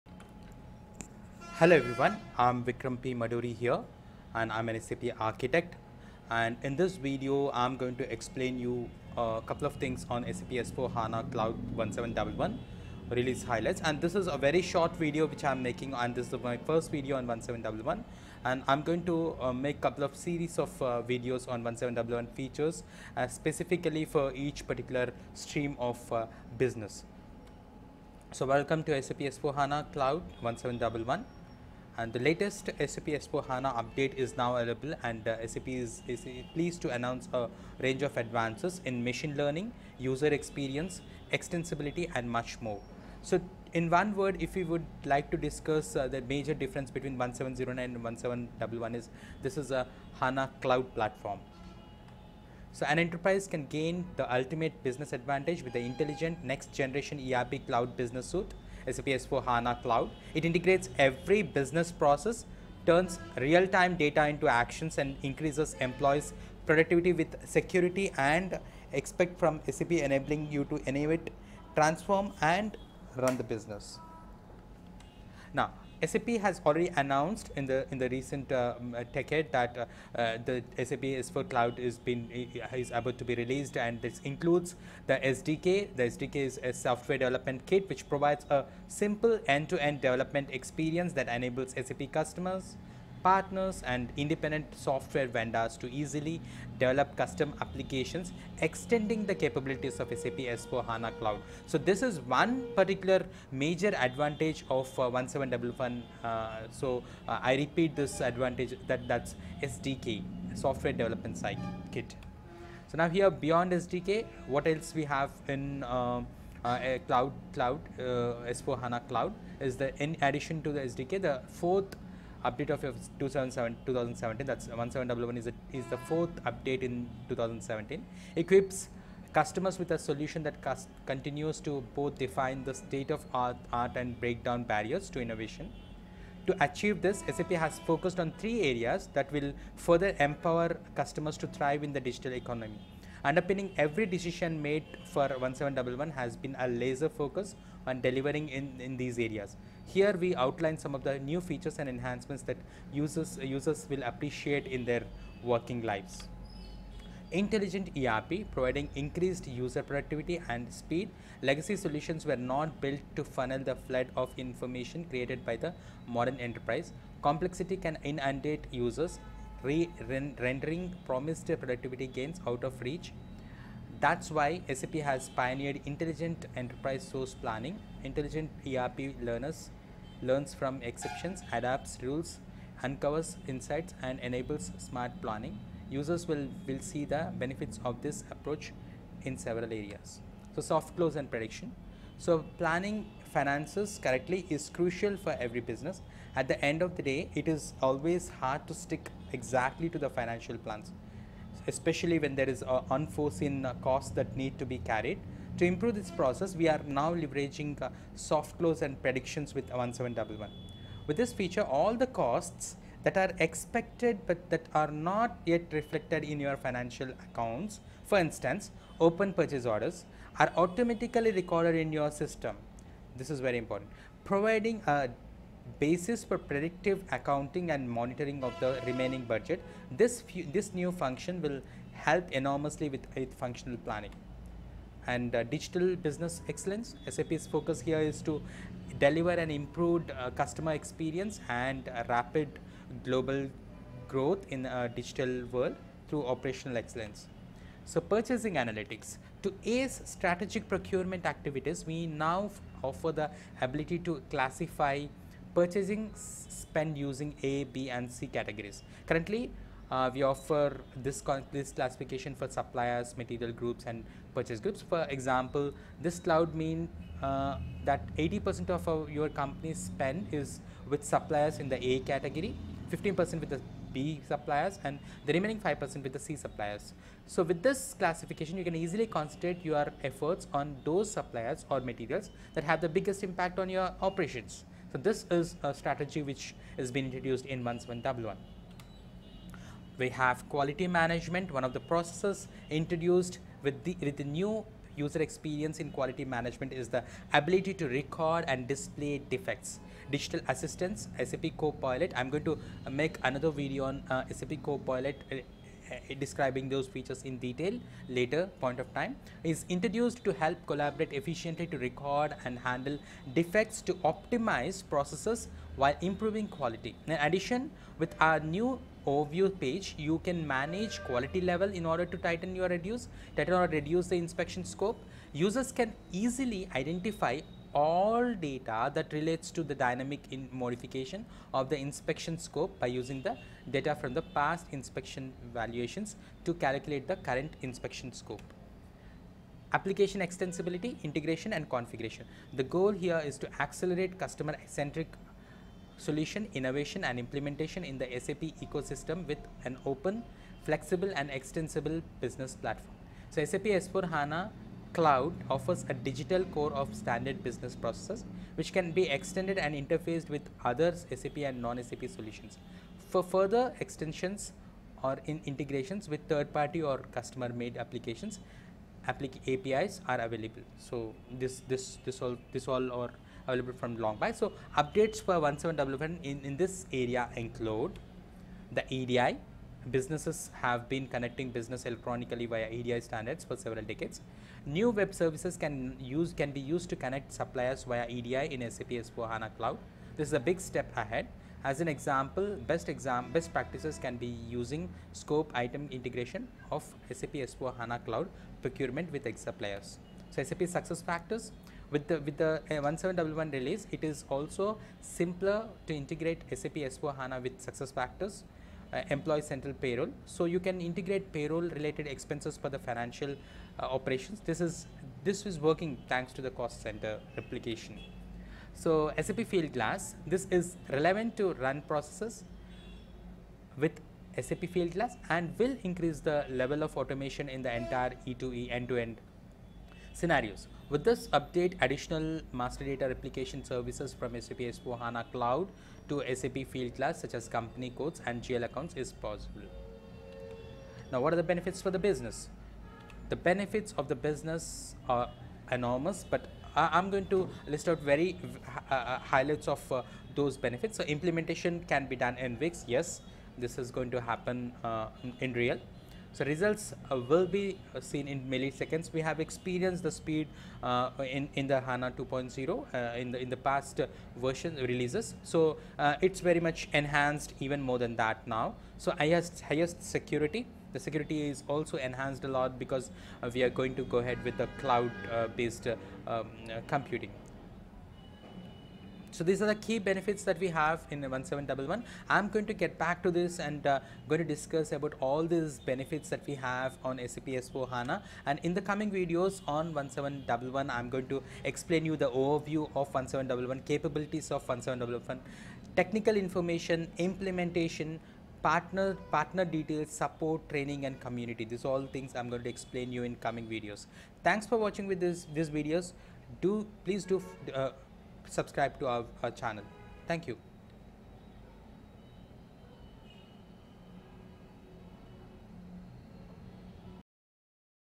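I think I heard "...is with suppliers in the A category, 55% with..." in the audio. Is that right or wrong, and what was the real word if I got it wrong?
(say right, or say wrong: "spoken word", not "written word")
wrong: "15", not "55".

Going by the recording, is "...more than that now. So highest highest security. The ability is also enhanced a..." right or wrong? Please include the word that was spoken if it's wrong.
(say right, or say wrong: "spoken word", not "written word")
wrong: "security", not "ability".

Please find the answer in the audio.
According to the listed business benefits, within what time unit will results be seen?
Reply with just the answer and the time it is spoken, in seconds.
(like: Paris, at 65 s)
milliseconds, at 458 s.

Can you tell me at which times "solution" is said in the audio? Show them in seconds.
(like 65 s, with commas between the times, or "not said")
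129 s, 161 s, 346 s, 362 s.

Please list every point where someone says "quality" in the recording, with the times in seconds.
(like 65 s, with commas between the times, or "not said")
290 s, 295 s, 316 s, 321 s.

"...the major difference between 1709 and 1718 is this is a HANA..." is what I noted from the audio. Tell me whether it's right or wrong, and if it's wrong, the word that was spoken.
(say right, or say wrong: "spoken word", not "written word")
wrong: "1711", not "1718".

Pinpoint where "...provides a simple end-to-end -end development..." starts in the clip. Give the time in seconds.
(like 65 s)
88 s.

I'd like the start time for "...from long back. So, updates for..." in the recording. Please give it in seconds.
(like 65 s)
373 s.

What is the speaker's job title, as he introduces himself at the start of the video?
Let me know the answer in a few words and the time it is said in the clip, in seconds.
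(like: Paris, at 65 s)
SAP architect, at 4 s.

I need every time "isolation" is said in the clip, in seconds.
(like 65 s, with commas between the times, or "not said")
not said.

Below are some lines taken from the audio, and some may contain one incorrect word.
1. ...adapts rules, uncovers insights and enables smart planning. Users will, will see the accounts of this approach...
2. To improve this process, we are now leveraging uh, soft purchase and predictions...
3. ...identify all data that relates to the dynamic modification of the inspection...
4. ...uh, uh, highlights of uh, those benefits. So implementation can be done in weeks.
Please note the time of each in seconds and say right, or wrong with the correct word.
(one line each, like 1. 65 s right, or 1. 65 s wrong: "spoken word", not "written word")
1. 181 s wrong: "benefits", not "accounts"
2. 205 s wrong: "close", not "purchase"
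3. 326 s right
4. 448 s right.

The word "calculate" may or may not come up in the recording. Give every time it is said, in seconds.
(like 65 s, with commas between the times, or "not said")
336 s.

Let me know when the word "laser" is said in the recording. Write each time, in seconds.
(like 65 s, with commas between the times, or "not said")
146 s.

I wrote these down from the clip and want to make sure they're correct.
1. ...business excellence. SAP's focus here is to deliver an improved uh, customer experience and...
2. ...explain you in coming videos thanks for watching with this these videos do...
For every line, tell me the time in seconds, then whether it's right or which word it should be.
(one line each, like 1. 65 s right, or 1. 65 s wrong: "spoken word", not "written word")
1. 235 s right
2. 502 s right.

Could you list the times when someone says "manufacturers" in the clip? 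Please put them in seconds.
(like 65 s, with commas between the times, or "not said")
not said.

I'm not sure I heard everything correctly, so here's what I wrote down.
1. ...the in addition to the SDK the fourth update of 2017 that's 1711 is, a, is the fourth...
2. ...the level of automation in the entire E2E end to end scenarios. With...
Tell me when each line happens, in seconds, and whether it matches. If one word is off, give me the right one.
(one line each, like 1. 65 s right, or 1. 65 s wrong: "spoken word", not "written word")
1. 119 s right
2. 426 s right.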